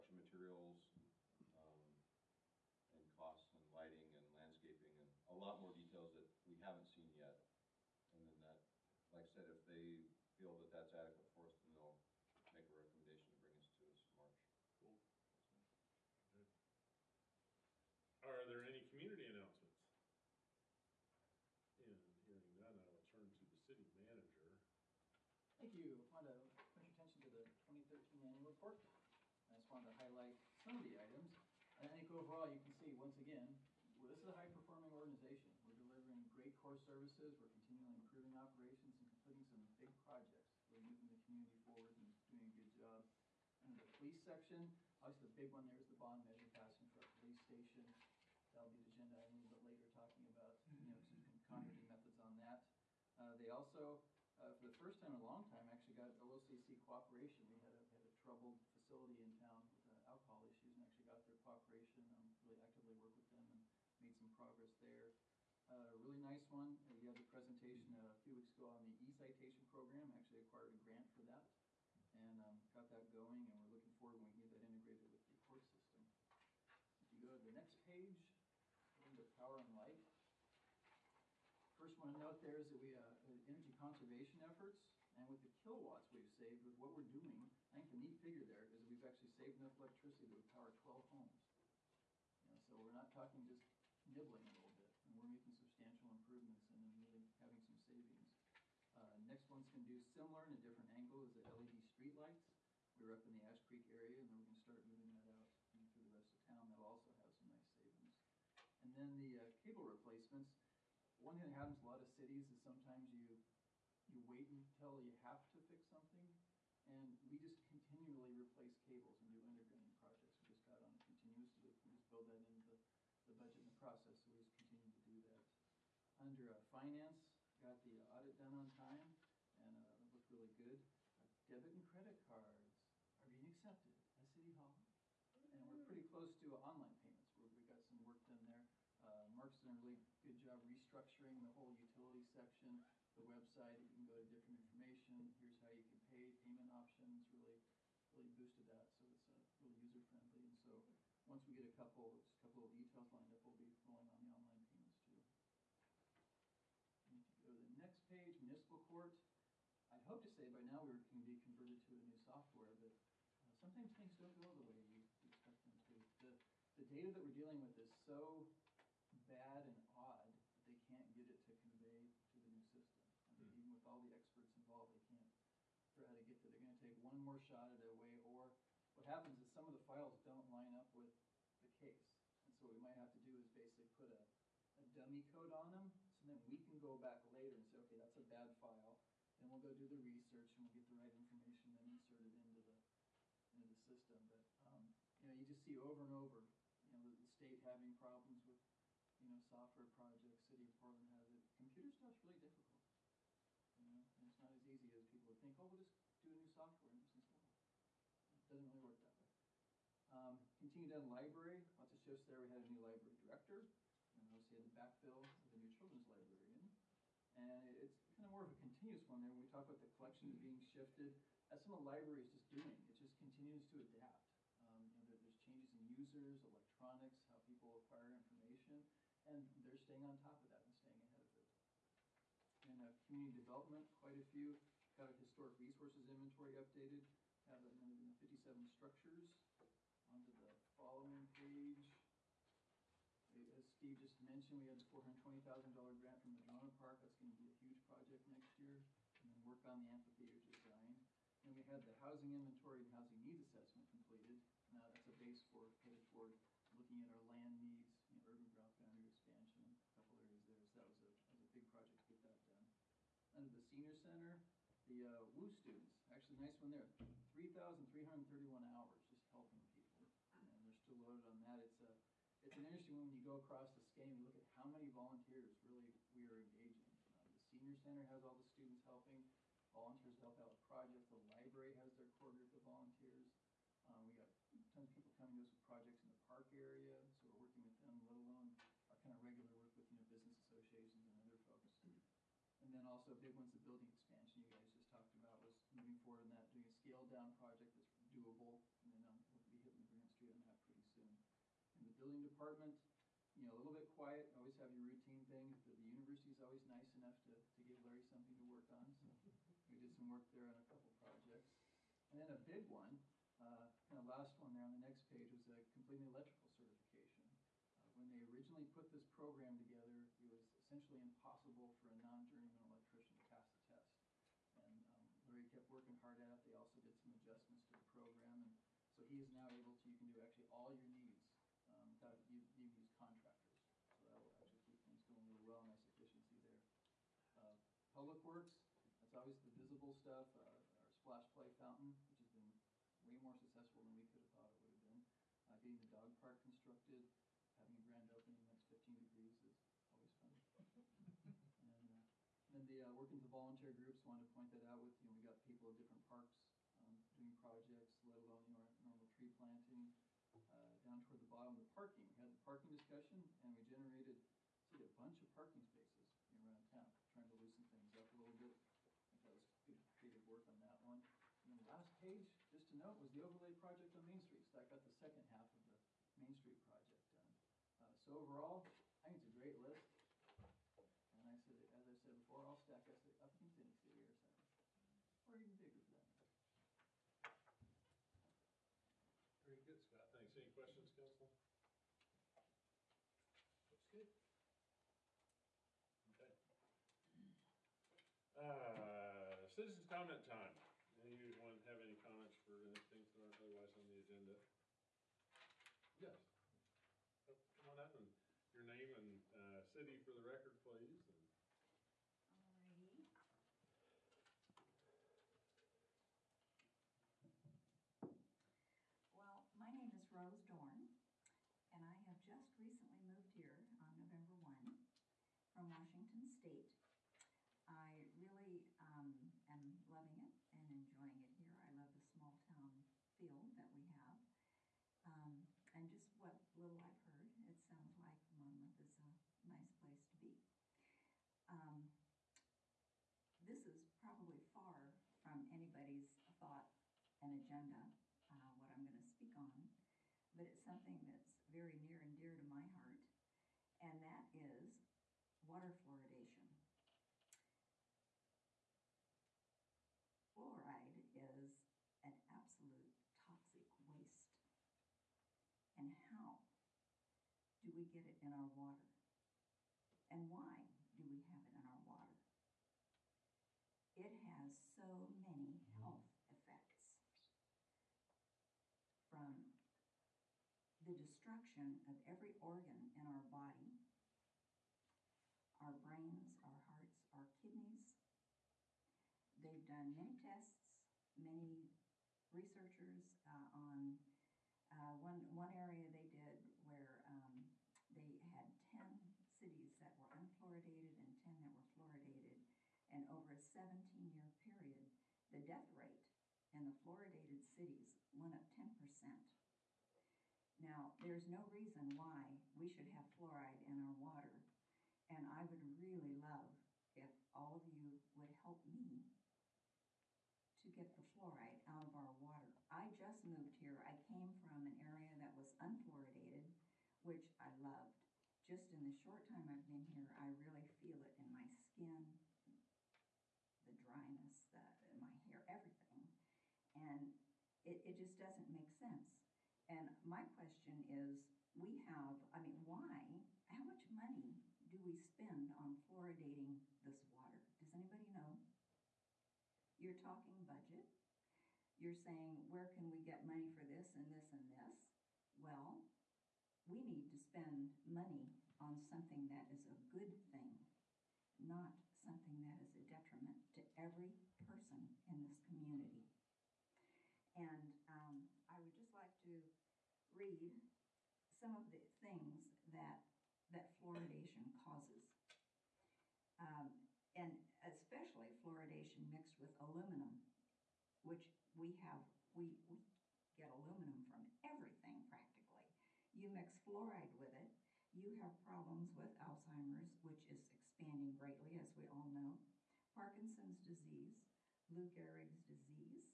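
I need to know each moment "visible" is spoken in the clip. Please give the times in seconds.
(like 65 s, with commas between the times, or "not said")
339 s.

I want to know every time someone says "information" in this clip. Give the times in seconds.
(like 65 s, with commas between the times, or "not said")
144 s, 191 s, 228 s.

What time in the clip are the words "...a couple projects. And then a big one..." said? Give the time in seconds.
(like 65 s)
310 s.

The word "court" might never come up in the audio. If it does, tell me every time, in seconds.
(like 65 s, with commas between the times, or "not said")
75 s, 158 s.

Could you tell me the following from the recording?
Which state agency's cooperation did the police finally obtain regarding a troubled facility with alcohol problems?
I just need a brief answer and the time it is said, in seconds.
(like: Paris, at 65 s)
OLCC, at 56 s.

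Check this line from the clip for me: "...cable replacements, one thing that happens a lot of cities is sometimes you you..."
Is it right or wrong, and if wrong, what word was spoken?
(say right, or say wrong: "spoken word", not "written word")
right.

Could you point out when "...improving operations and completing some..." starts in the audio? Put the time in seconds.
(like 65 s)
37 s.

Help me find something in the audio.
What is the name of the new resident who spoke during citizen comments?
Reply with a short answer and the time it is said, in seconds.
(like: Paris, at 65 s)
Rose Dorn, at 420 s.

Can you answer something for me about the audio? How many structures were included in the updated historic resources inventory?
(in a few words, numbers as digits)
157.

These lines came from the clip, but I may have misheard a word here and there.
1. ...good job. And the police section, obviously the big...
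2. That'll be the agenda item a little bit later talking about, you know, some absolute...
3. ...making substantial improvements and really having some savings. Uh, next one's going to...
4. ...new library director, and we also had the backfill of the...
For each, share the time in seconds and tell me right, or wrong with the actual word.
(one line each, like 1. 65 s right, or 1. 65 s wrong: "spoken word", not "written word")
1. 42 s right
2. 48 s wrong: "concrete", not "absolute"
3. 95 s right
4. 212 s right.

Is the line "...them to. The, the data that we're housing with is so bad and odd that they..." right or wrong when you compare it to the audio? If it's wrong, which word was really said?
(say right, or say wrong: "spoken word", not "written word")
wrong: "dealing", not "housing".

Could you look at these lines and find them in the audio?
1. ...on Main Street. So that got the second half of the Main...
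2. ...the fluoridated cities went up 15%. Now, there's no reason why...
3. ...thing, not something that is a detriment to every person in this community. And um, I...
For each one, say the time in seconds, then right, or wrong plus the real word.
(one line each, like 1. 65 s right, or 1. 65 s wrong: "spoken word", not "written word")
1. 373 s right
2. 506 s wrong: "10", not "15"
3. 560 s right.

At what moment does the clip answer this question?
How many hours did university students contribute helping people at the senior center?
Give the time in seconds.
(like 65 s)
267 s.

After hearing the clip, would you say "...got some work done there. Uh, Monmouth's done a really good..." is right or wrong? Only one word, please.
wrong.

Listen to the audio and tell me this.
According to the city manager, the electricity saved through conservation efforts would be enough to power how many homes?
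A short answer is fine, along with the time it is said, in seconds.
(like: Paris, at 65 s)
12, at 90 s.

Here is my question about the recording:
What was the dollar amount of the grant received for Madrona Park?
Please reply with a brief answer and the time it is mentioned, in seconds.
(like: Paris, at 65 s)
$420,000, at 244 s.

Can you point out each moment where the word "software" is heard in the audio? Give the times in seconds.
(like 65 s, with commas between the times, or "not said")
162 s, 199 s, 206 s.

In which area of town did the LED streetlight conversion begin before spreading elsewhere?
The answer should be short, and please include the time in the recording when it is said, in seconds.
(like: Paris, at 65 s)
Ash Creek, at 103 s.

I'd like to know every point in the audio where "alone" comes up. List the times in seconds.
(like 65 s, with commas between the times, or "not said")
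288 s, 358 s.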